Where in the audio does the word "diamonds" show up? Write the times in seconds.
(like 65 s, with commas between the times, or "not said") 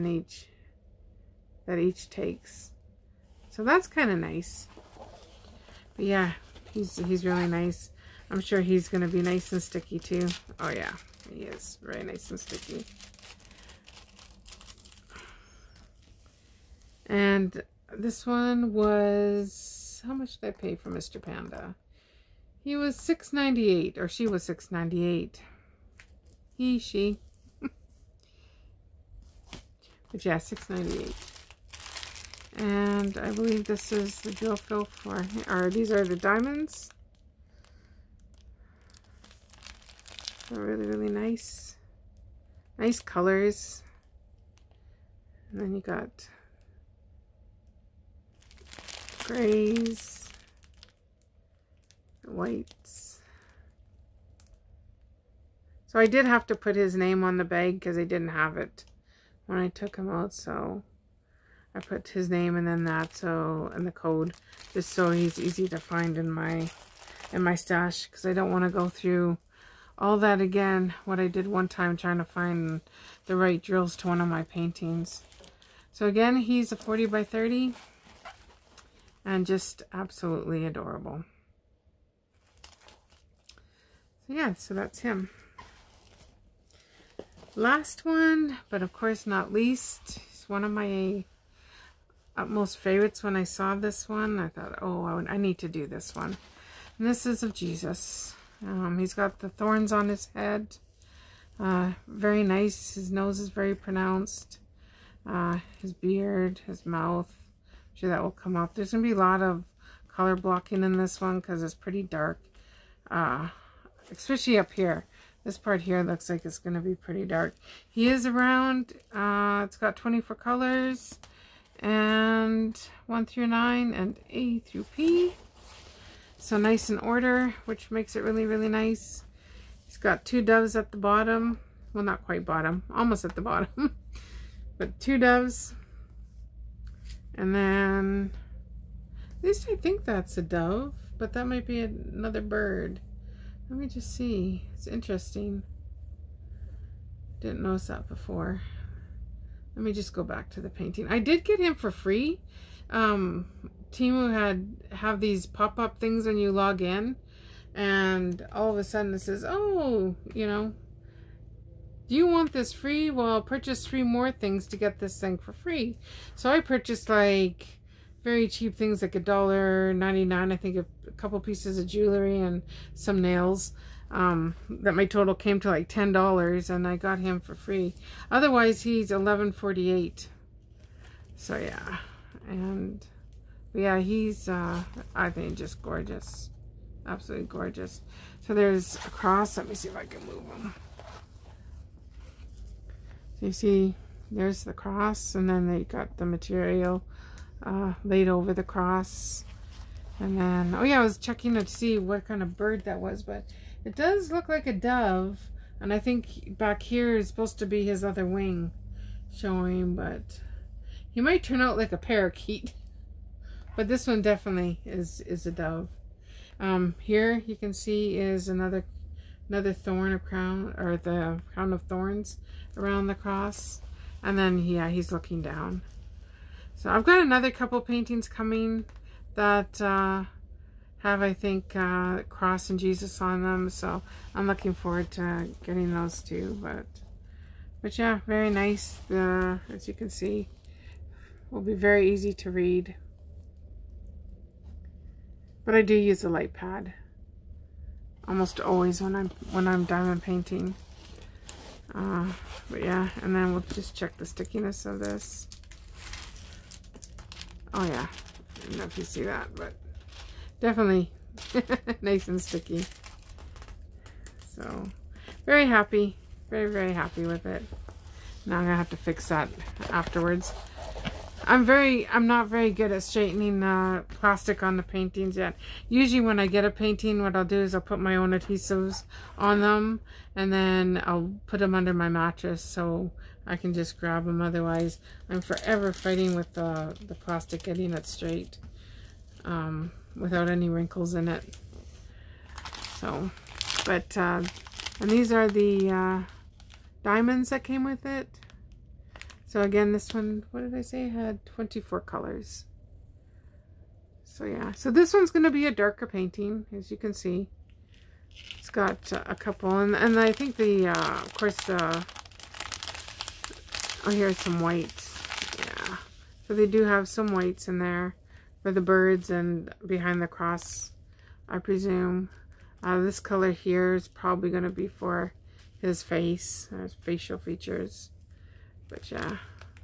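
36 s, 249 s, 297 s.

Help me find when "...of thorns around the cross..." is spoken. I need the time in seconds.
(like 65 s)
221 s.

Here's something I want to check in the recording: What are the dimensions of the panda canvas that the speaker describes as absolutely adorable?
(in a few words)
40 by 30.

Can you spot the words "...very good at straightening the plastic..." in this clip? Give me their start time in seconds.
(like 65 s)
272 s.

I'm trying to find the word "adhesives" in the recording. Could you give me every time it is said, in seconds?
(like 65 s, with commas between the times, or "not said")
278 s.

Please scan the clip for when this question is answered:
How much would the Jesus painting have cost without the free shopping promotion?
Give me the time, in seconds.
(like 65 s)
179 s.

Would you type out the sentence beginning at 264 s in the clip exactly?
So very happy, very, very happy with it.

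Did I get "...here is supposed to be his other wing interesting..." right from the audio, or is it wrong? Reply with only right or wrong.
wrong.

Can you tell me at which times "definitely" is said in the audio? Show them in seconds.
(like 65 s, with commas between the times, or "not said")
214 s, 260 s.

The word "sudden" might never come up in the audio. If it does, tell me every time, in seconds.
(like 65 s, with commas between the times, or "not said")
158 s.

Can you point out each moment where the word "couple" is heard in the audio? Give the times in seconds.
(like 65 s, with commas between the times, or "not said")
171 s, 227 s, 309 s.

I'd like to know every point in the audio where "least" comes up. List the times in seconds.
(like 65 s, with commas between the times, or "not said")
89 s, 139 s.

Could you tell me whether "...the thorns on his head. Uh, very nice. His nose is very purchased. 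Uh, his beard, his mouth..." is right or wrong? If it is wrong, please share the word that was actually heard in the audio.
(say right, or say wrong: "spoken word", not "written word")
wrong: "pronounced", not "purchased".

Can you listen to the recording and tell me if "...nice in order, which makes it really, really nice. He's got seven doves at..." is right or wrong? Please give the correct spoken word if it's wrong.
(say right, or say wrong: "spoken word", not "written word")
wrong: "two", not "seven".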